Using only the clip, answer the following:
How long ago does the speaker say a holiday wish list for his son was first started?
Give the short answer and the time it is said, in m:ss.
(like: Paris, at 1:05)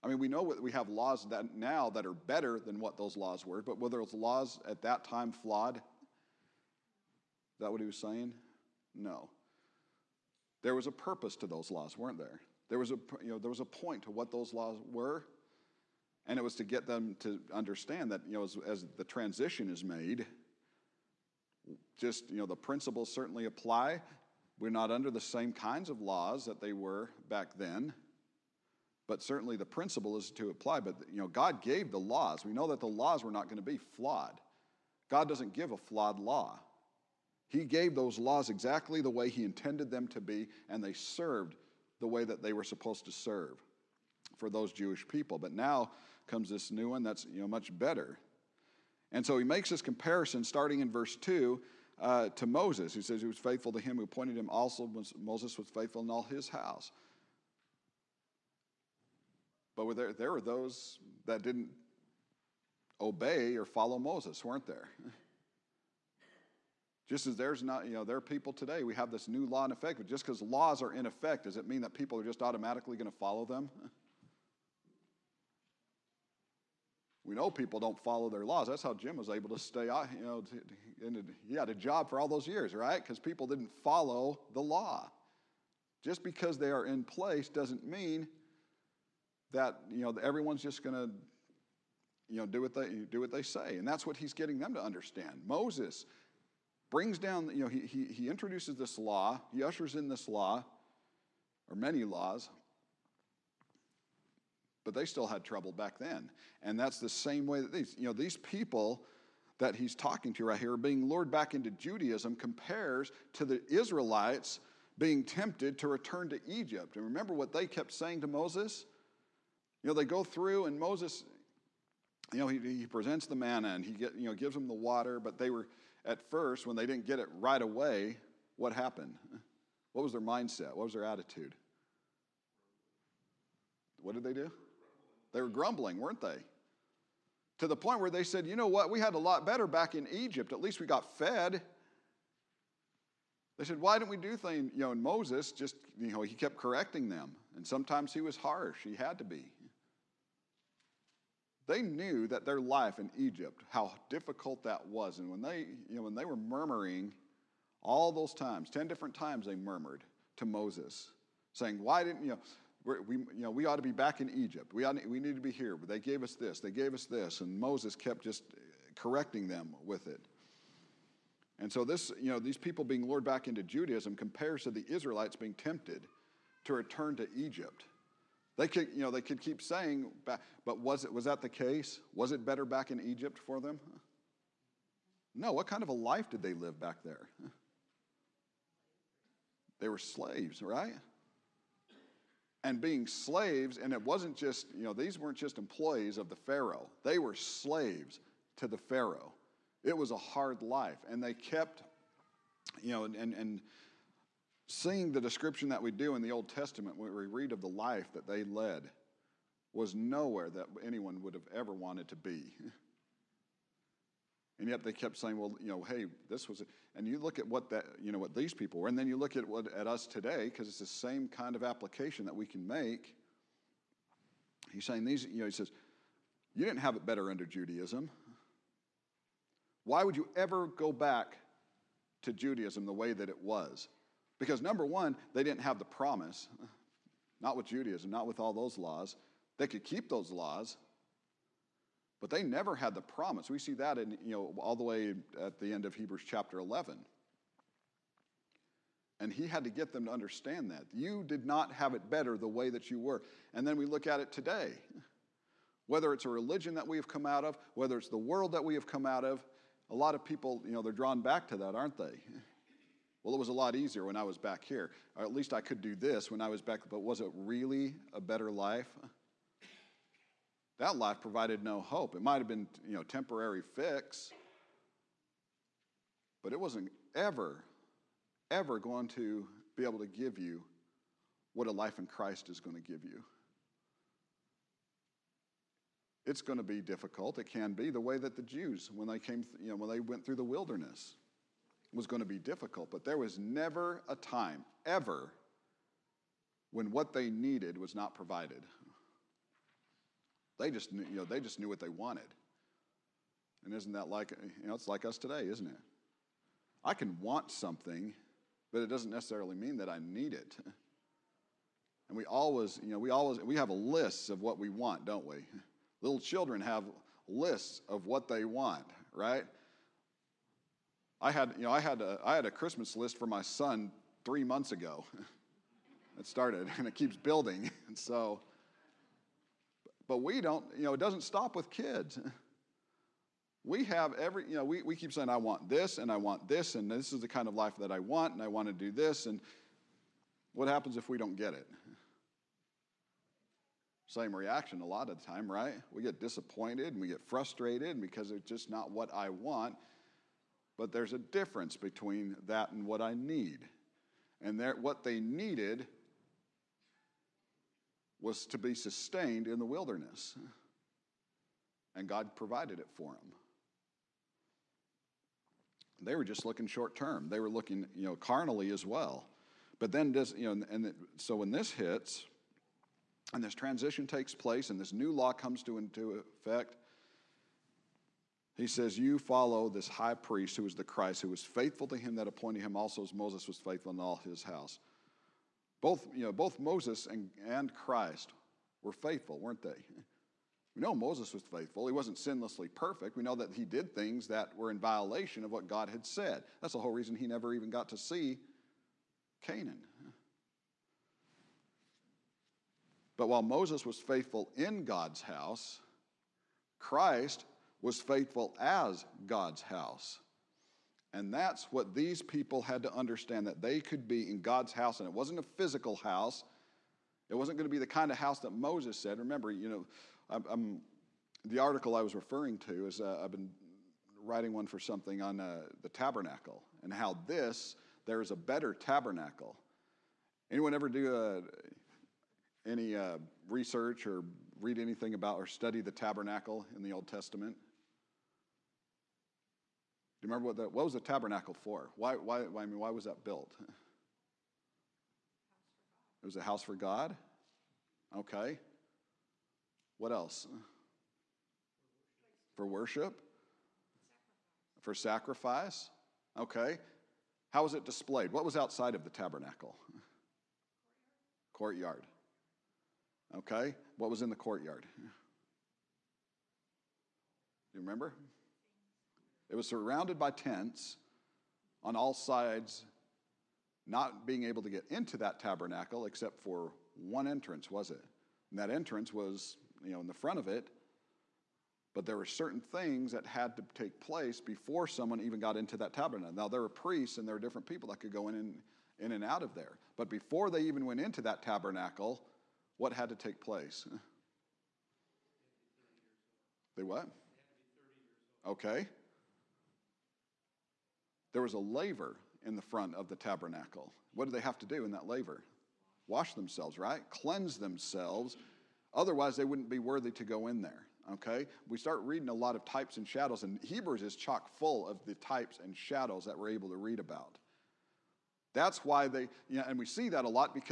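Three months ago, at 5:24.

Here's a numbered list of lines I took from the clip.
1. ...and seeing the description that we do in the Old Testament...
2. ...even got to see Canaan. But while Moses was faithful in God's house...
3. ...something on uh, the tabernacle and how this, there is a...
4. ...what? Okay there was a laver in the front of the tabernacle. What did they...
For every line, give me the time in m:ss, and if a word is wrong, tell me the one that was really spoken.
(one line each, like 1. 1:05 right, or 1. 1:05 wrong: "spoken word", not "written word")
1. 3:23 right
2. 6:37 right
3. 7:04 right
4. 8:16 right.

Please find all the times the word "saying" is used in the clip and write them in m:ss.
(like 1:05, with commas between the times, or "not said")
0:07, 1:57, 2:41, 2:59, 3:35, 3:44, 5:35.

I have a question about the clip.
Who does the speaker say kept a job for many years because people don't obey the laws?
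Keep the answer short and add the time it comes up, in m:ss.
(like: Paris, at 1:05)
Jim, at 1:18.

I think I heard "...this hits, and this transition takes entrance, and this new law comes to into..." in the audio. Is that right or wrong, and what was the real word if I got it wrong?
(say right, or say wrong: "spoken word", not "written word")
wrong: "place", not "entrance".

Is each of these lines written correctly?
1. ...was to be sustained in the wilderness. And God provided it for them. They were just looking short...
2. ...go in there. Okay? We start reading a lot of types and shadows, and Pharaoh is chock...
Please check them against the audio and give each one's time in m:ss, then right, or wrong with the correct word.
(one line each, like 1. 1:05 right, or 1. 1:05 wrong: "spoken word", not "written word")
1. 5:58 right
2. 8:30 wrong: "Hebrews", not "Pharaoh".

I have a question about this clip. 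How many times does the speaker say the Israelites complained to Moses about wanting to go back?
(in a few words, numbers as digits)
10.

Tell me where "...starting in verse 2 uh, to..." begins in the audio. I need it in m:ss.
0:50.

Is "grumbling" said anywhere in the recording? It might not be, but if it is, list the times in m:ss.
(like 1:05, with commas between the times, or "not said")
2:15.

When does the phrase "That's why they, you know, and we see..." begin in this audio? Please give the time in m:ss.
8:38.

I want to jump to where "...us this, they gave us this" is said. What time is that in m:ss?
2:46.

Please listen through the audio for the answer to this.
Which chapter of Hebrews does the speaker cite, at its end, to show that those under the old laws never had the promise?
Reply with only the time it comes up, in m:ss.
4:05.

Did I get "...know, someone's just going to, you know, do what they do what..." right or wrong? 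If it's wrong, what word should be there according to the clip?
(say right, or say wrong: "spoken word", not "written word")
wrong: "everyone", not "someone".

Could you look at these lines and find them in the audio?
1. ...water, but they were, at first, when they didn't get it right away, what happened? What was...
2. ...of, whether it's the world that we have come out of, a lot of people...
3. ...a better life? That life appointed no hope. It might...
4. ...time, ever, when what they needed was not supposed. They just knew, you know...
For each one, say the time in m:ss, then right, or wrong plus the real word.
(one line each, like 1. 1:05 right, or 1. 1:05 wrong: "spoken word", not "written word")
1. 2:04 right
2. 4:17 right
3. 4:28 wrong: "provided", not "appointed"
4. 4:54 wrong: "provided", not "supposed".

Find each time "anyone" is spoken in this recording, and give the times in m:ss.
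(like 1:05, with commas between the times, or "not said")
3:30, 7:10.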